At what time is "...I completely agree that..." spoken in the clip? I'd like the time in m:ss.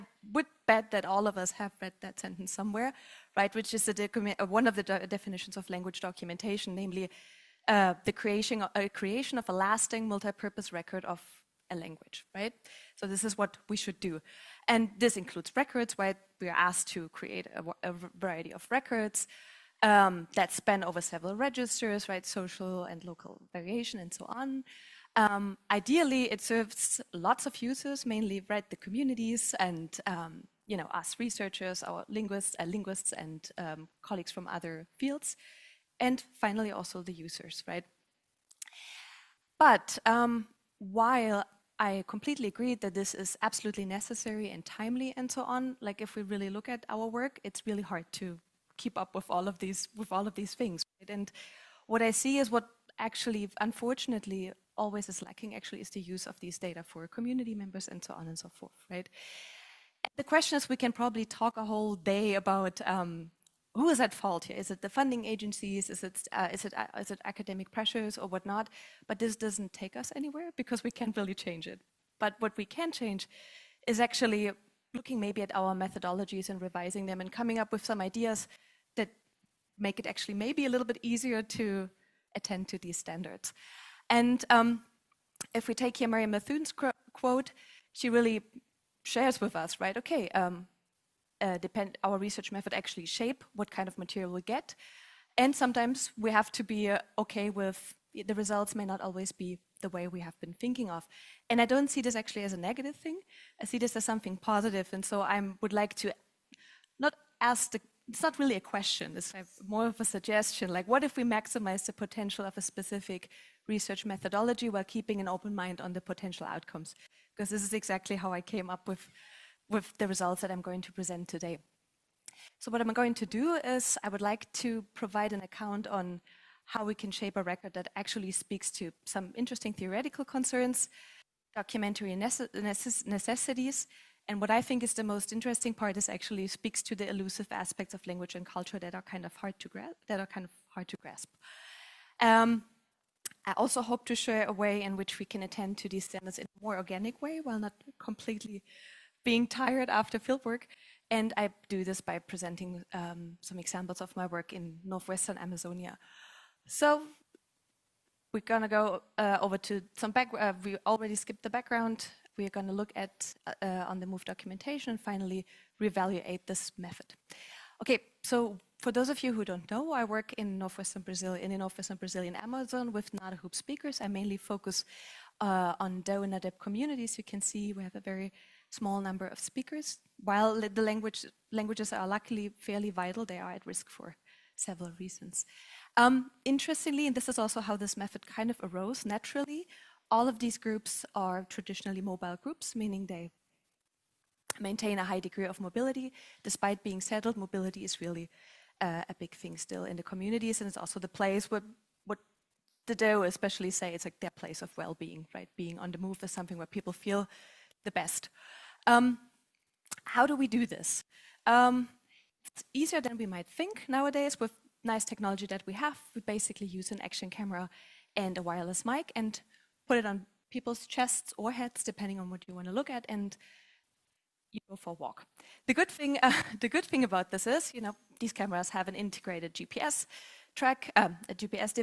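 0:41.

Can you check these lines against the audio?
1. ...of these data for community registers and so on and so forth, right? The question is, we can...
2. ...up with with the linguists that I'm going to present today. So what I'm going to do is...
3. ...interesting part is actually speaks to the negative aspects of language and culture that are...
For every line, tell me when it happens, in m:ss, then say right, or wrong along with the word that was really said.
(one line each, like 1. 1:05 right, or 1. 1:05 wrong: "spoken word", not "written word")
1. 0:56 wrong: "members", not "registers"
2. 1:58 wrong: "results", not "linguists"
3. 2:15 wrong: "elusive", not "negative".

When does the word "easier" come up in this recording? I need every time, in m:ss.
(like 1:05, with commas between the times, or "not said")
1:21, 3:32.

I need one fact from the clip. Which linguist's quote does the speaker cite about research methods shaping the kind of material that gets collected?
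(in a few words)
Marianne Mithun.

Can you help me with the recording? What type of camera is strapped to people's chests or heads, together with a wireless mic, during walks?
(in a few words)
action camera.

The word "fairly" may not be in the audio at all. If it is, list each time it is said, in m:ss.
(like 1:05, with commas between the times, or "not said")
3:02.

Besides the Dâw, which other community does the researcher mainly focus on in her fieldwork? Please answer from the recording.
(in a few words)
Nadëb.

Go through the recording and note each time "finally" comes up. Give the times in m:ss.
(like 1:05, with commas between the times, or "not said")
0:36, 2:45.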